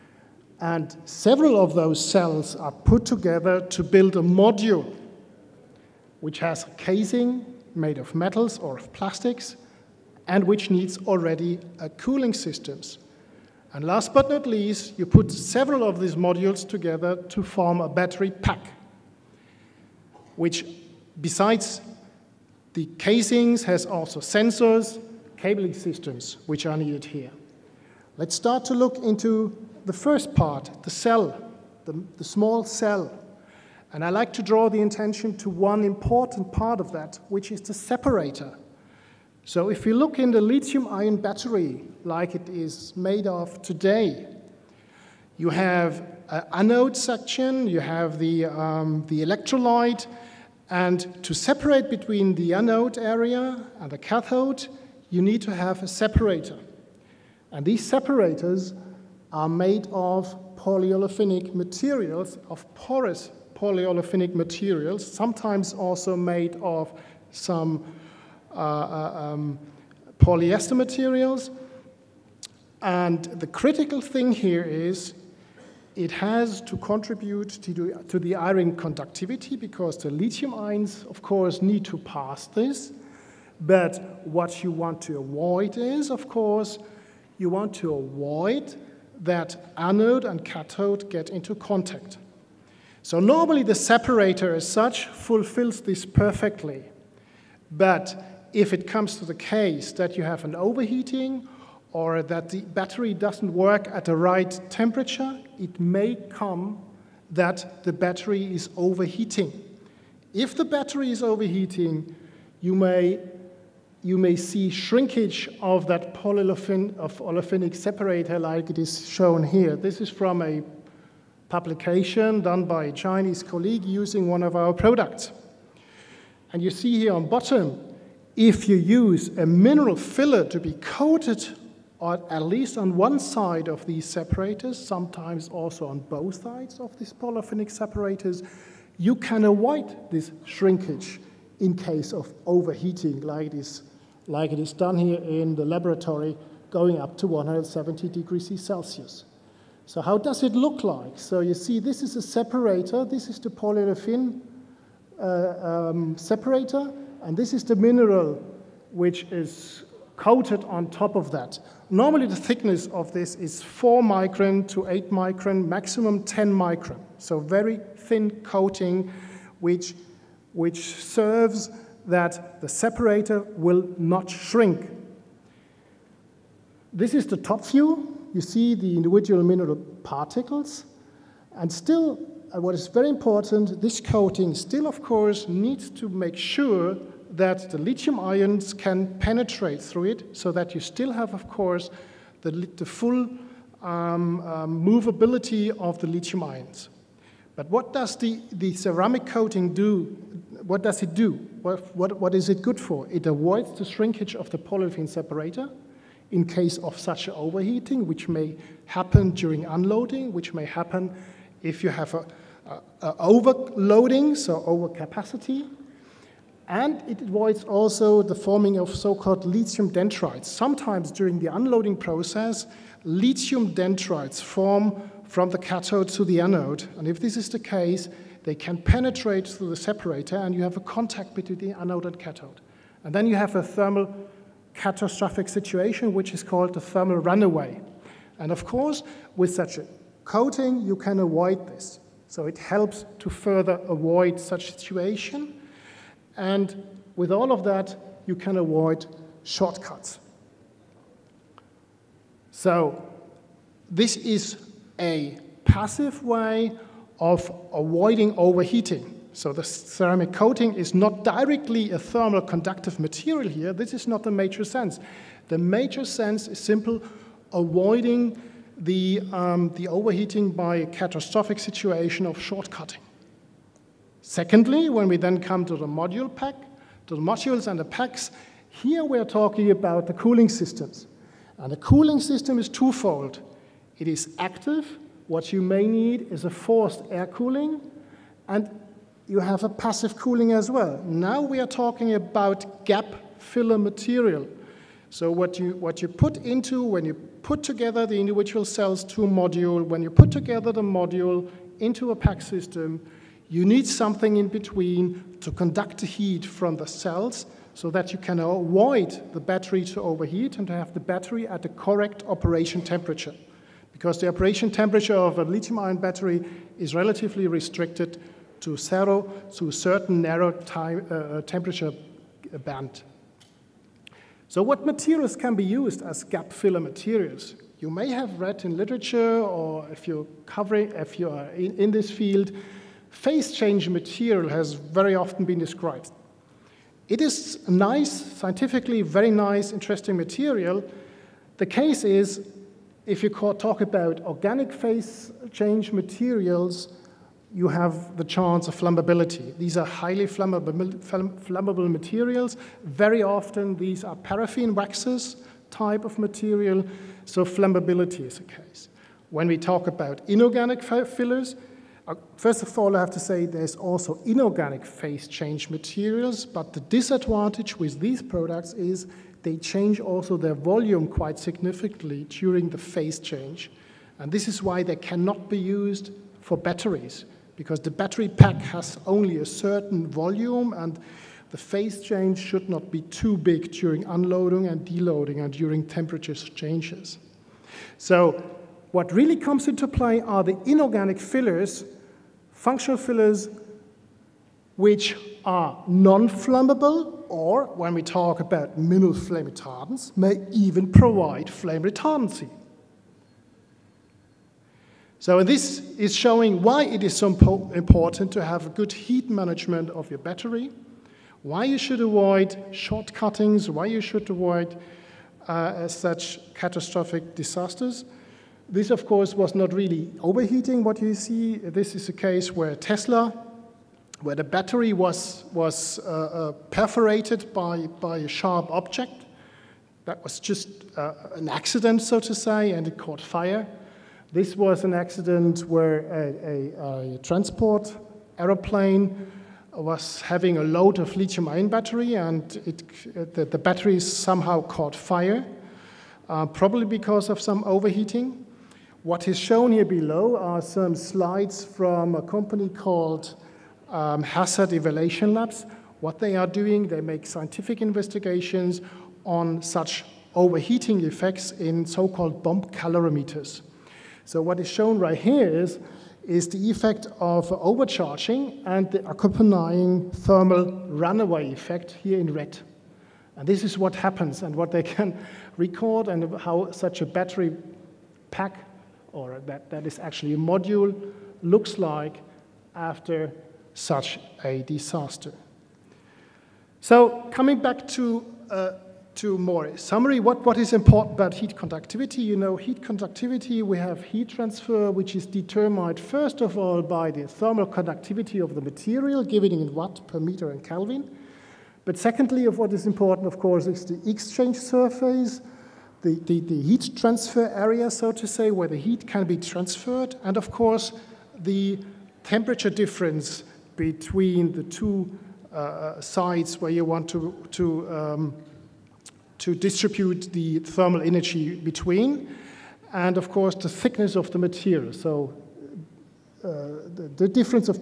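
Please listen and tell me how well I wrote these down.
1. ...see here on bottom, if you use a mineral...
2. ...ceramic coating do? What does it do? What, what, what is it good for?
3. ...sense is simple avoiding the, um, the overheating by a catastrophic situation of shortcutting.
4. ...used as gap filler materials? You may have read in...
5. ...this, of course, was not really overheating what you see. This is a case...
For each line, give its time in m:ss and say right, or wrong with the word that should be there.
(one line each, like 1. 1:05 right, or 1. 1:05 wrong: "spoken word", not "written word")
1. 2:06 right
2. 3:18 right
3. 4:26 right
4. 5:25 right
5. 6:58 right.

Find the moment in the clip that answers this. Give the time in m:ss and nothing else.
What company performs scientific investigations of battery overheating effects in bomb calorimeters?
7:34.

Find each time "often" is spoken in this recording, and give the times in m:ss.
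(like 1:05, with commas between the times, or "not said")
5:35, 5:53.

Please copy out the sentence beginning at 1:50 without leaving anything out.
If the battery is overheating, you may, you may see shrinkage of that polyolefin, of olefinic separator like it is shown here.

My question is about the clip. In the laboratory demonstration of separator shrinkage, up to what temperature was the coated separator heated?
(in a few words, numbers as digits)
170 degrees Celsius.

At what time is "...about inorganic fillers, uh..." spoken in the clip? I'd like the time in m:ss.
5:59.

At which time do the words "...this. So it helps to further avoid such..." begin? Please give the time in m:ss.
4:01.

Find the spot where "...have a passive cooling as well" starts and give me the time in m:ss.
4:49.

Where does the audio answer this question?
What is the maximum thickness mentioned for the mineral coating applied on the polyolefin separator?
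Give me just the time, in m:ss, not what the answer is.
2:45.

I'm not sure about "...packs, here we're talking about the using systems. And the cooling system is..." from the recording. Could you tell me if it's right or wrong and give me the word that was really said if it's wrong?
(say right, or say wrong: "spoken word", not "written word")
wrong: "cooling", not "using".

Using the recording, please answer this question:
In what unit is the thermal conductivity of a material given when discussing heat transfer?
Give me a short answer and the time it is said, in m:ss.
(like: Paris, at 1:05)
watt per meter and Kelvin, at 8:19.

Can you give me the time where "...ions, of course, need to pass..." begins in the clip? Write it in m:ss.
1:20.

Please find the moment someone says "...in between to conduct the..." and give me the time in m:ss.
5:04.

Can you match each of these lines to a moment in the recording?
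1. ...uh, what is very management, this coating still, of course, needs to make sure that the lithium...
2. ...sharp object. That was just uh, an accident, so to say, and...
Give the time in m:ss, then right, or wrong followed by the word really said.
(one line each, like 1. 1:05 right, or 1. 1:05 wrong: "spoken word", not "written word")
1. 3:02 wrong: "important", not "management"
2. 7:08 right.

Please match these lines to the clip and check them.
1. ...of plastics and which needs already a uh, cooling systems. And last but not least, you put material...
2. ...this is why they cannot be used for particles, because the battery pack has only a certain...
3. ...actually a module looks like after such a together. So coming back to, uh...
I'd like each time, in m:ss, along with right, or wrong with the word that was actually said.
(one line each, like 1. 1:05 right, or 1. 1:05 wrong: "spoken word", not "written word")
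1. 0:08 wrong: "several", not "material"
2. 6:14 wrong: "batteries", not "particles"
3. 7:59 wrong: "disaster", not "together".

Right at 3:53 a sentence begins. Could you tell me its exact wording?
And then you have a thermal catastrophic situation, which is called the thermal runaway.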